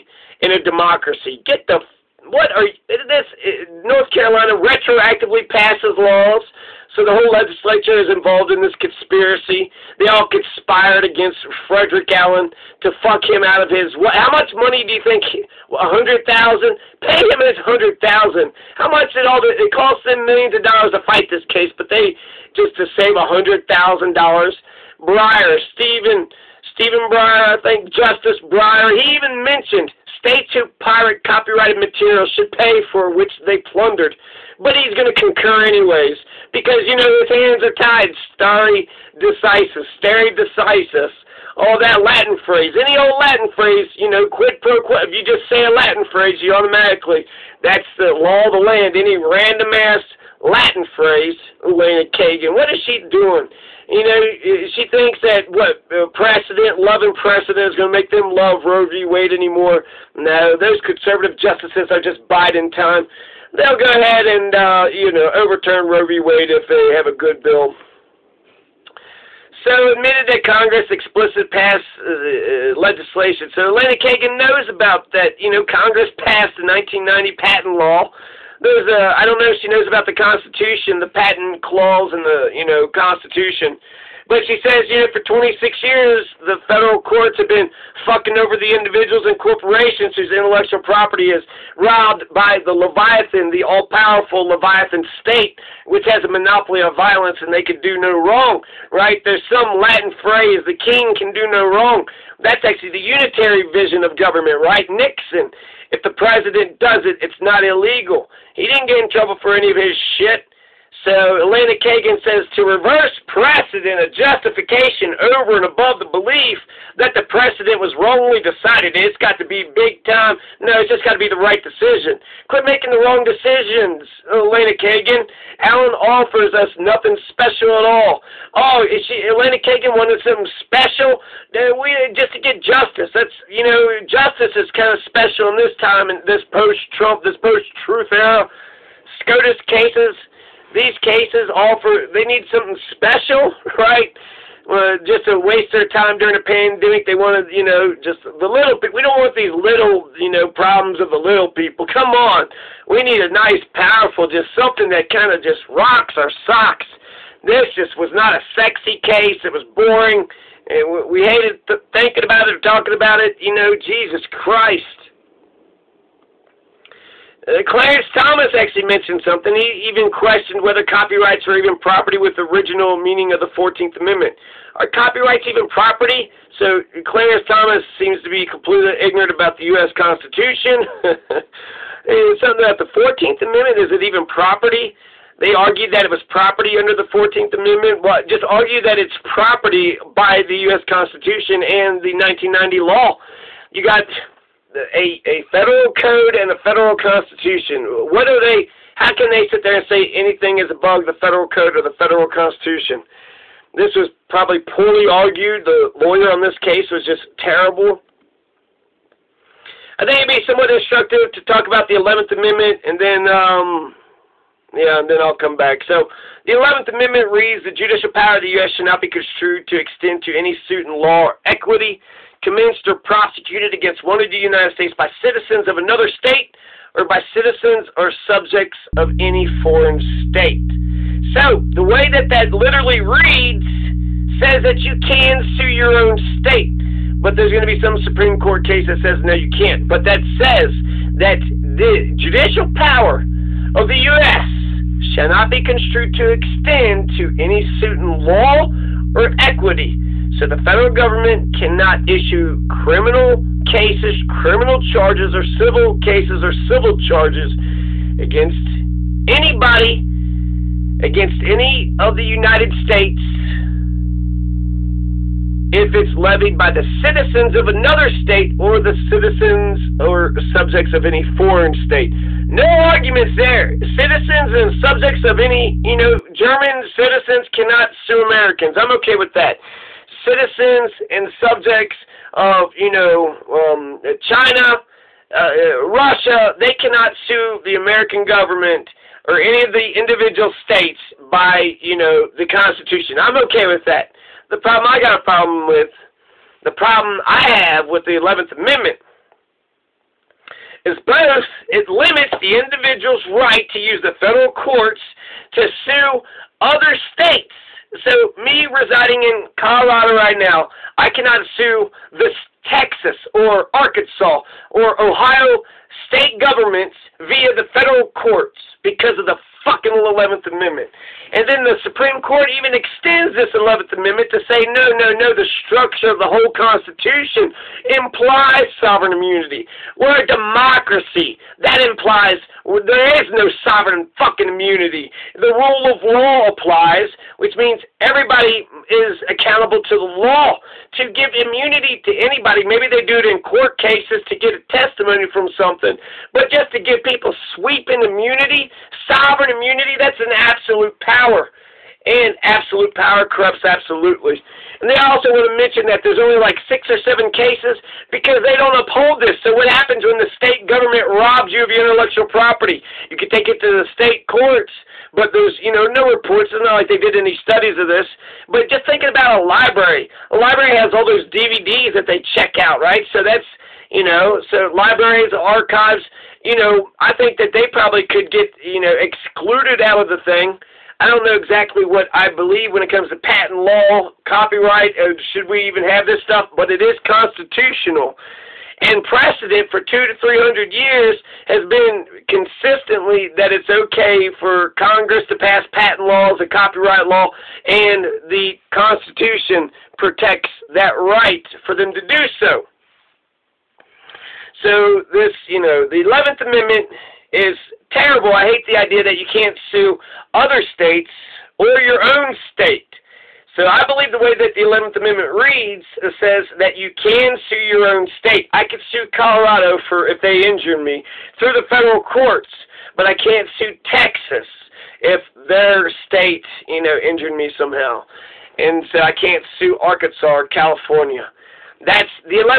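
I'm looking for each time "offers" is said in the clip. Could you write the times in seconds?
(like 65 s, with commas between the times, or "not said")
126 s, 141 s.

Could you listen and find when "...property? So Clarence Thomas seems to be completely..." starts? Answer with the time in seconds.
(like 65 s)
175 s.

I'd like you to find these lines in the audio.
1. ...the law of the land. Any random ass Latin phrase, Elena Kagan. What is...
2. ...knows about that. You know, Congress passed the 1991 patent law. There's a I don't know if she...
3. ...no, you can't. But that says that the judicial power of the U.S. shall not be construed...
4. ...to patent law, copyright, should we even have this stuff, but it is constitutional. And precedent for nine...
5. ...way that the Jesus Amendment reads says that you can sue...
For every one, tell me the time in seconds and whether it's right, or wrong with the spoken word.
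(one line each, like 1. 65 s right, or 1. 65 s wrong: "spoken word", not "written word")
1. 47 s right
2. 74 s wrong: "1990", not "1991"
3. 239 s right
4. 383 s wrong: "two", not "nine"
5. 414 s wrong: "Eleventh", not "Jesus".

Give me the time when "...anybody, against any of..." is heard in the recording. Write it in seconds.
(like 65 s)
259 s.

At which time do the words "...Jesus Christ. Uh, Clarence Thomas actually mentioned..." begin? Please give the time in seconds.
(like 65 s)
163 s.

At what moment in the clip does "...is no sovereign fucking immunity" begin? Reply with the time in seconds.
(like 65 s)
333 s.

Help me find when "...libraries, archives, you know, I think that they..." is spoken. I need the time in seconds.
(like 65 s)
374 s.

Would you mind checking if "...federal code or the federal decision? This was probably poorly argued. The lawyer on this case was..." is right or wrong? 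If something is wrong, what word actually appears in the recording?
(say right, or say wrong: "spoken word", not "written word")
wrong: "constitution", not "decision".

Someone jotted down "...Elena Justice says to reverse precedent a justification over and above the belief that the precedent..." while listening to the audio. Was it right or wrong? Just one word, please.
wrong.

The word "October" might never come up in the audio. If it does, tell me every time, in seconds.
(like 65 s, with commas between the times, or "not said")
not said.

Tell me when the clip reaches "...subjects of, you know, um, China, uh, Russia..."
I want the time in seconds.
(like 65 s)
281 s.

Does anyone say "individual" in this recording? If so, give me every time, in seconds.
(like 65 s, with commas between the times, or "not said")
88 s, 289 s, 302 s.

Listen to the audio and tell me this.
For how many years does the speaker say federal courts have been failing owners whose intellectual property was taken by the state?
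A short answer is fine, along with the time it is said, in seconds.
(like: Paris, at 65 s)
26, at 85 s.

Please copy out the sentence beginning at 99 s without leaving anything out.
There's some Latin phrase, the king can do no wrong.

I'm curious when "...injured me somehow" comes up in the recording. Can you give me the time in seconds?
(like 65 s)
426 s.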